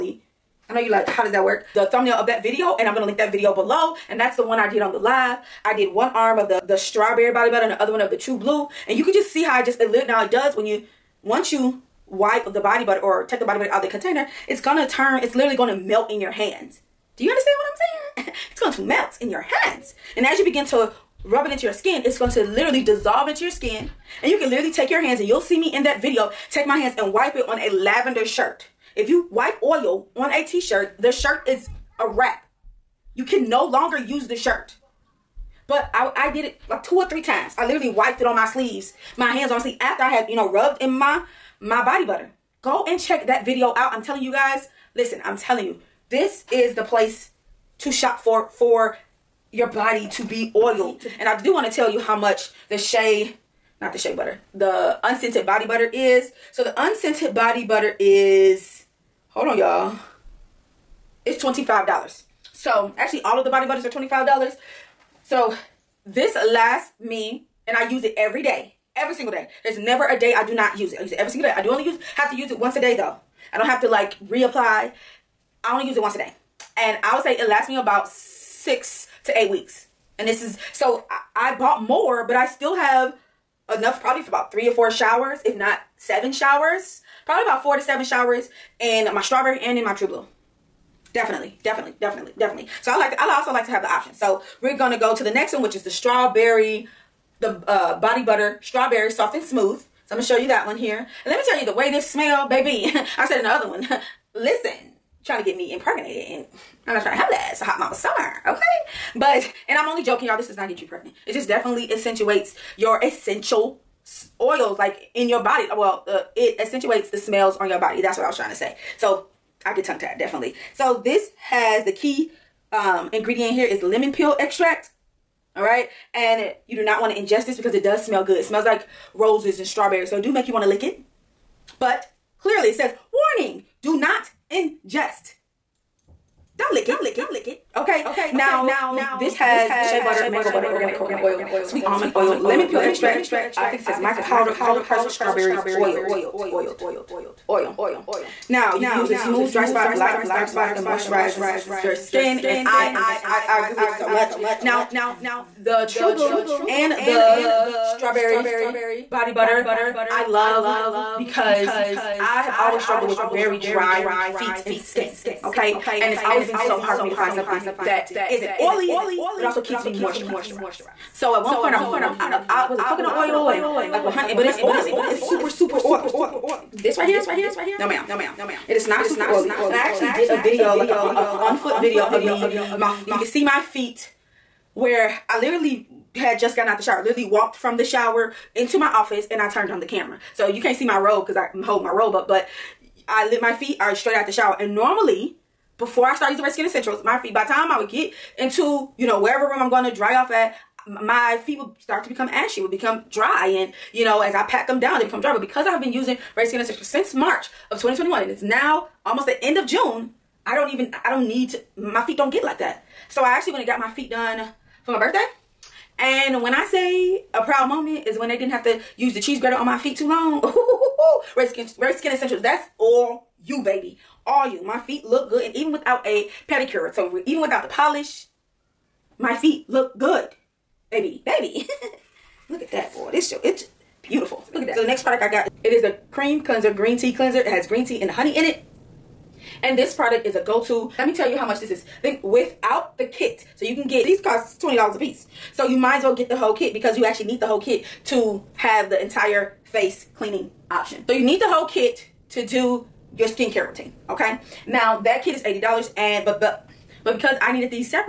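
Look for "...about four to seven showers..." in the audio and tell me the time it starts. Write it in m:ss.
1:27.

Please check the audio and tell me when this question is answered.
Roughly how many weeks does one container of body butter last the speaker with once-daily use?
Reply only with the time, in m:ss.
1:18.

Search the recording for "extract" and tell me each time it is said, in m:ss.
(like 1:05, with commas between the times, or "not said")
2:04, 2:22.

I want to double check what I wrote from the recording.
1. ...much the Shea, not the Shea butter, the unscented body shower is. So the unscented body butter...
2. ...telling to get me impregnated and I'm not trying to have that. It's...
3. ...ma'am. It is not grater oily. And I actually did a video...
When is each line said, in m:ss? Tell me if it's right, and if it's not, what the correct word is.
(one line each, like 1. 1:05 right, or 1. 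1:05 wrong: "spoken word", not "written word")
1. 0:52 wrong: "butter", not "shower"
2. 1:45 wrong: "trying", not "telling"
3. 2:57 wrong: "super", not "grater".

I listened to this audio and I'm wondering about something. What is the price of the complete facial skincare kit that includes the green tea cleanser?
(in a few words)
$80.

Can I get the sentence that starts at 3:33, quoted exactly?
So I actually went and got my feet done for my birthday.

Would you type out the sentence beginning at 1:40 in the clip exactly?
So I'm going to show you that one here.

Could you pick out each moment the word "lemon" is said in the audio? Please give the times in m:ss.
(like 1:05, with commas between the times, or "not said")
2:03, 2:22.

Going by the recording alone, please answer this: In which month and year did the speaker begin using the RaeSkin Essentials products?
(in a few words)
March 2021.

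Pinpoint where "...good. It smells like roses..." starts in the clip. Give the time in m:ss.
2:08.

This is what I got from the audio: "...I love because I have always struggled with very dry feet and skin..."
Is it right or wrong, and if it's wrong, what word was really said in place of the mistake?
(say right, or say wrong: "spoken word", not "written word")
right.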